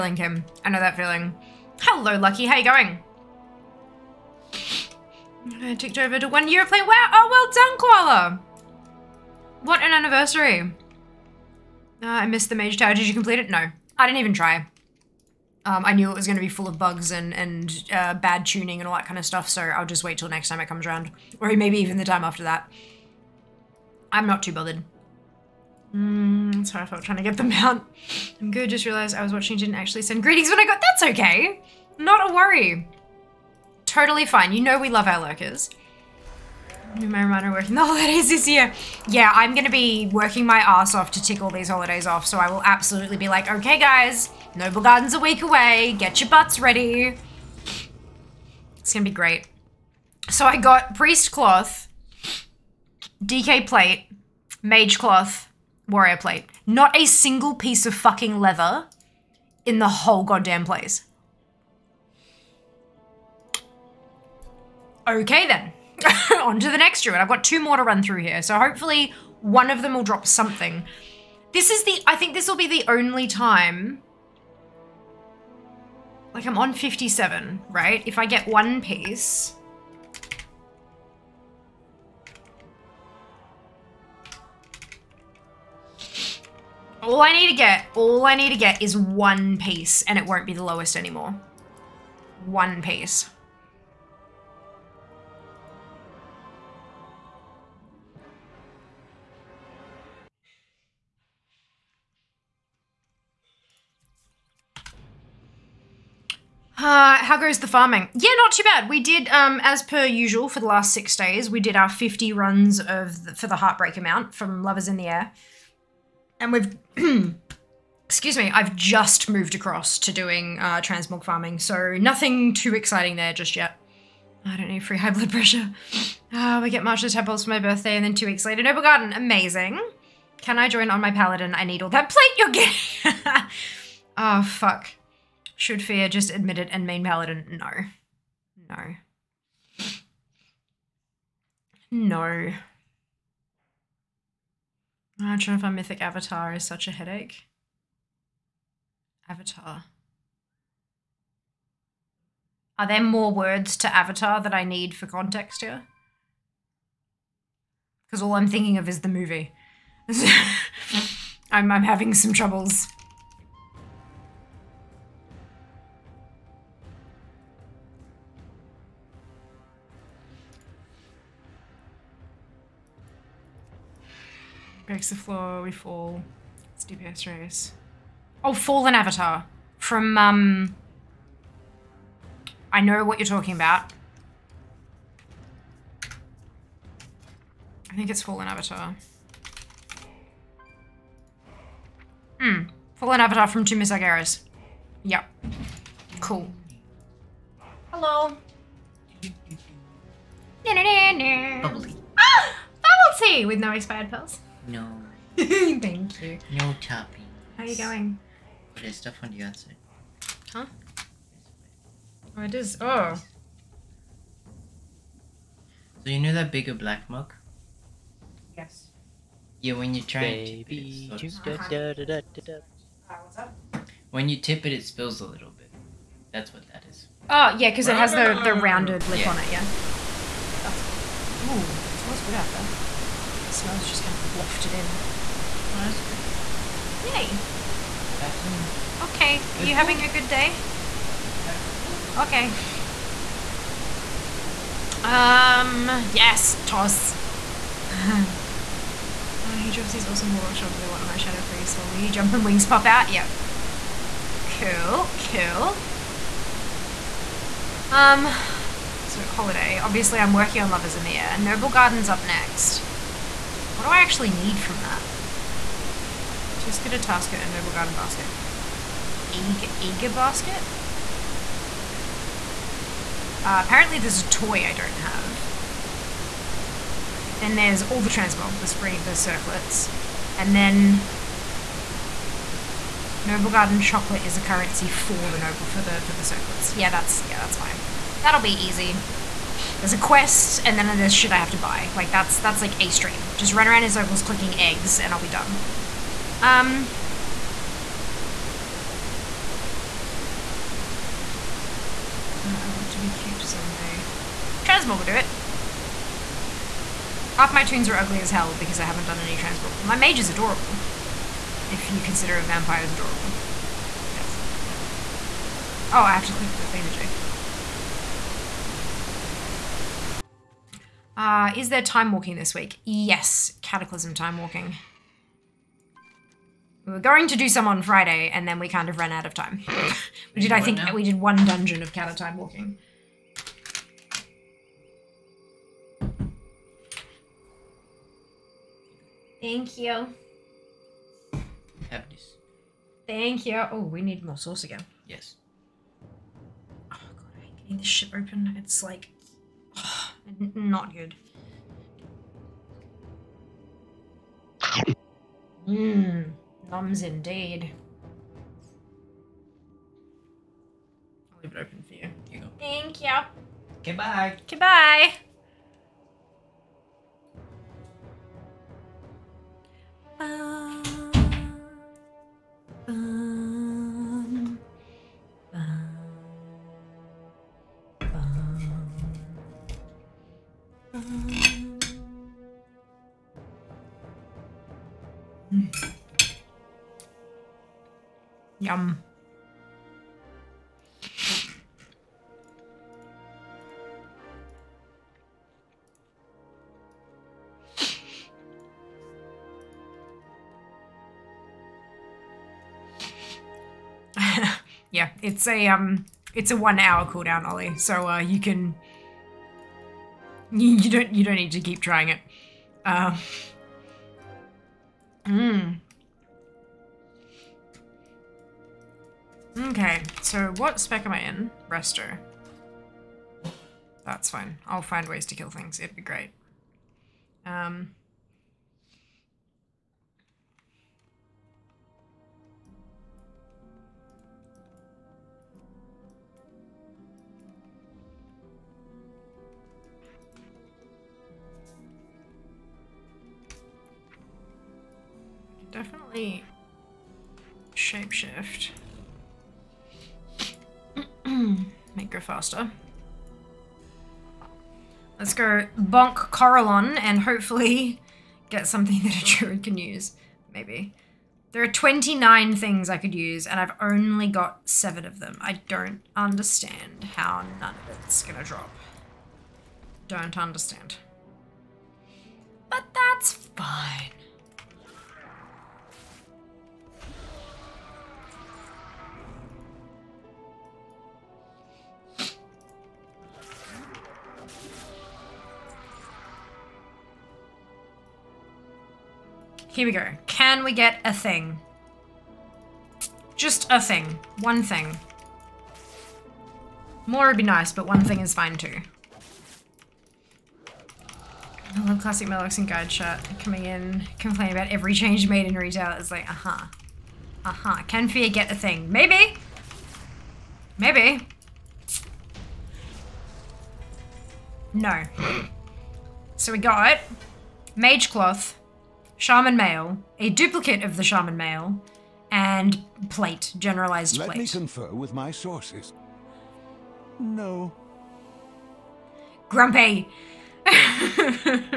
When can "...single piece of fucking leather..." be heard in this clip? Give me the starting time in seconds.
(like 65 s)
57 s.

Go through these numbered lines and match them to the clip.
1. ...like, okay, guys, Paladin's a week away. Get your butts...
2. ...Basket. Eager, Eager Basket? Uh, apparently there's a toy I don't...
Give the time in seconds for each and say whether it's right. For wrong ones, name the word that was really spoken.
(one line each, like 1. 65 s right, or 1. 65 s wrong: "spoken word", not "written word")
1. 43 s wrong: "Noblegarden", not "Paladin"
2. 267 s right.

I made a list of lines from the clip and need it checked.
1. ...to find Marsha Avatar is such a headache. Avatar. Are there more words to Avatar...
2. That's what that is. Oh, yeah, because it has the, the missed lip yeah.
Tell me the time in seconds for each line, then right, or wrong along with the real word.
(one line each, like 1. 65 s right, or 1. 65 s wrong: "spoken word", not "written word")
1. 145 s wrong: "Mythic", not "Marsha"
2. 226 s wrong: "rounded", not "missed".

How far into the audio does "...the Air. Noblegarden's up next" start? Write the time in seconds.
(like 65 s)
261 s.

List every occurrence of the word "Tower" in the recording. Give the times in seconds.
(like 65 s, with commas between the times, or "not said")
12 s.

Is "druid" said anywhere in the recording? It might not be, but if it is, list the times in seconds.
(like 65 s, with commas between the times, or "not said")
67 s, 459 s.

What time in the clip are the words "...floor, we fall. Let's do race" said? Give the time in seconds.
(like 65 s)
175 s.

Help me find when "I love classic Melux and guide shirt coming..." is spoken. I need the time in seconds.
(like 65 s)
501 s.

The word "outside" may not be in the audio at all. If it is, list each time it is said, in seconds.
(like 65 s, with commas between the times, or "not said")
209 s.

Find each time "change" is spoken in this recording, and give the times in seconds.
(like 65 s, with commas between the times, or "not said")
504 s.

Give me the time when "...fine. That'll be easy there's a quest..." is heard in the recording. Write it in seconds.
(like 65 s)
287 s.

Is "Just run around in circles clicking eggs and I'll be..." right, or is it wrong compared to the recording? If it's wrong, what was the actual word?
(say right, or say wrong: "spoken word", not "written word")
right.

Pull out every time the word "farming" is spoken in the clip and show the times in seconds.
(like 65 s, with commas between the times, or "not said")
107 s, 121 s.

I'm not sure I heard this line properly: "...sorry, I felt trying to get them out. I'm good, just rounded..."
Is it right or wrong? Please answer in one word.
wrong.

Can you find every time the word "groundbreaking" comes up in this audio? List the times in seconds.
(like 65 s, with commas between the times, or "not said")
not said.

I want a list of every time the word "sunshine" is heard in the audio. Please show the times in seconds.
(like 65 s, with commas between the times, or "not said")
not said.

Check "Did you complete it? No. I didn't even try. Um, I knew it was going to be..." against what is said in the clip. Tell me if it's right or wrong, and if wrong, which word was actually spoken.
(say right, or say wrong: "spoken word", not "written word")
right.